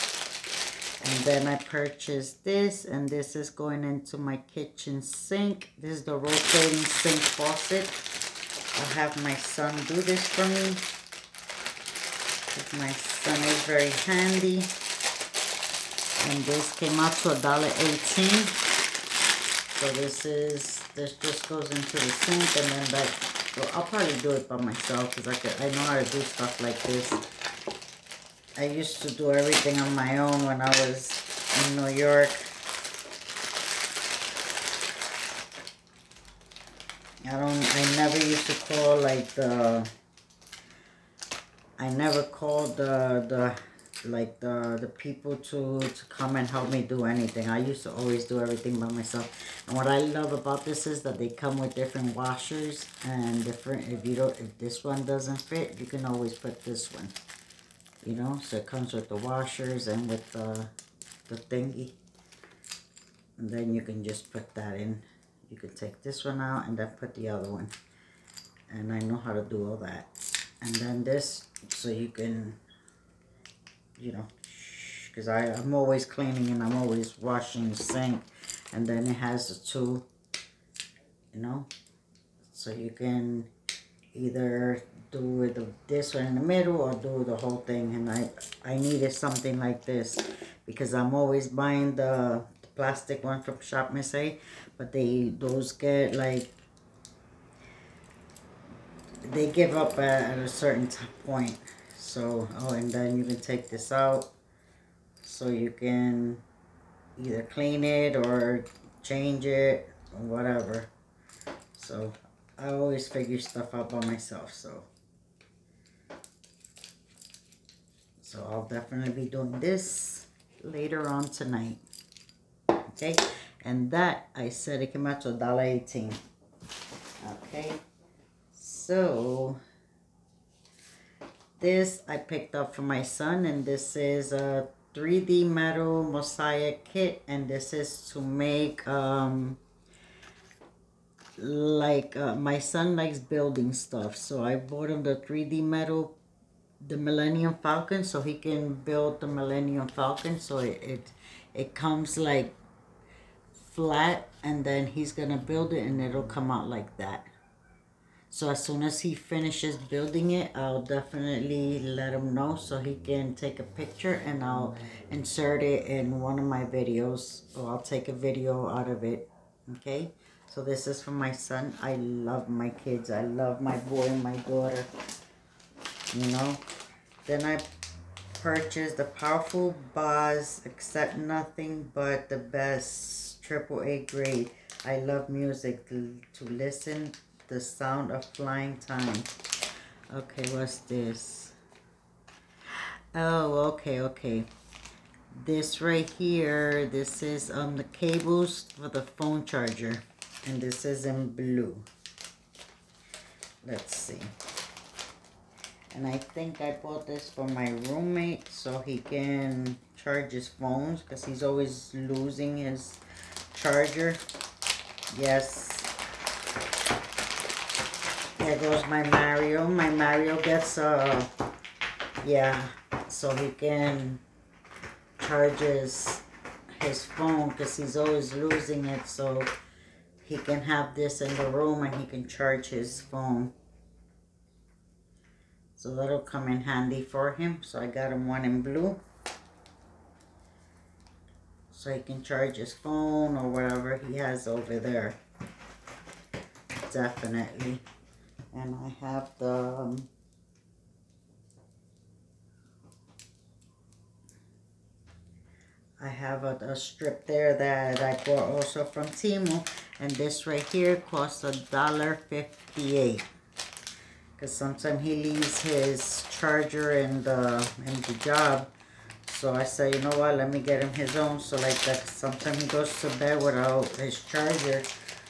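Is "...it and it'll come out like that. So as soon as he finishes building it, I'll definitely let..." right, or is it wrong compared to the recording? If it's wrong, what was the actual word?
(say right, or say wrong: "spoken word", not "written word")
right.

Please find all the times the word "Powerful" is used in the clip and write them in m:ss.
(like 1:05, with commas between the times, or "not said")
2:59.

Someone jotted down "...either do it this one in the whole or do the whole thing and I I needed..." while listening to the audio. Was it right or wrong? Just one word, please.
wrong.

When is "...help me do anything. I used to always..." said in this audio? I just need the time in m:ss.
0:46.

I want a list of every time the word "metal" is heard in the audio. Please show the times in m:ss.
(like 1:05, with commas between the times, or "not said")
2:15, 2:25.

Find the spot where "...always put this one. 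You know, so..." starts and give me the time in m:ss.
0:56.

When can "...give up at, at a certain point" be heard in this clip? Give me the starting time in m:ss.
1:39.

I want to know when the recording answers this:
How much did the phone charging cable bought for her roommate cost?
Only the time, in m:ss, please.
4:21.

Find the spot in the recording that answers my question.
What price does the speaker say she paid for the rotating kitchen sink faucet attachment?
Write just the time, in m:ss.
0:17.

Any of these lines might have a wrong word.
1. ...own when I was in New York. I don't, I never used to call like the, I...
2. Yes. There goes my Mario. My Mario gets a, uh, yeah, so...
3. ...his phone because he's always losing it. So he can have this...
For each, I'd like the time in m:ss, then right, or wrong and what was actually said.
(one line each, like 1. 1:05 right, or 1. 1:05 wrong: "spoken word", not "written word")
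1. 0:30 right
2. 3:35 right
3. 3:46 right.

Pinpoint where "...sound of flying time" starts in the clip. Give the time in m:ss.
3:07.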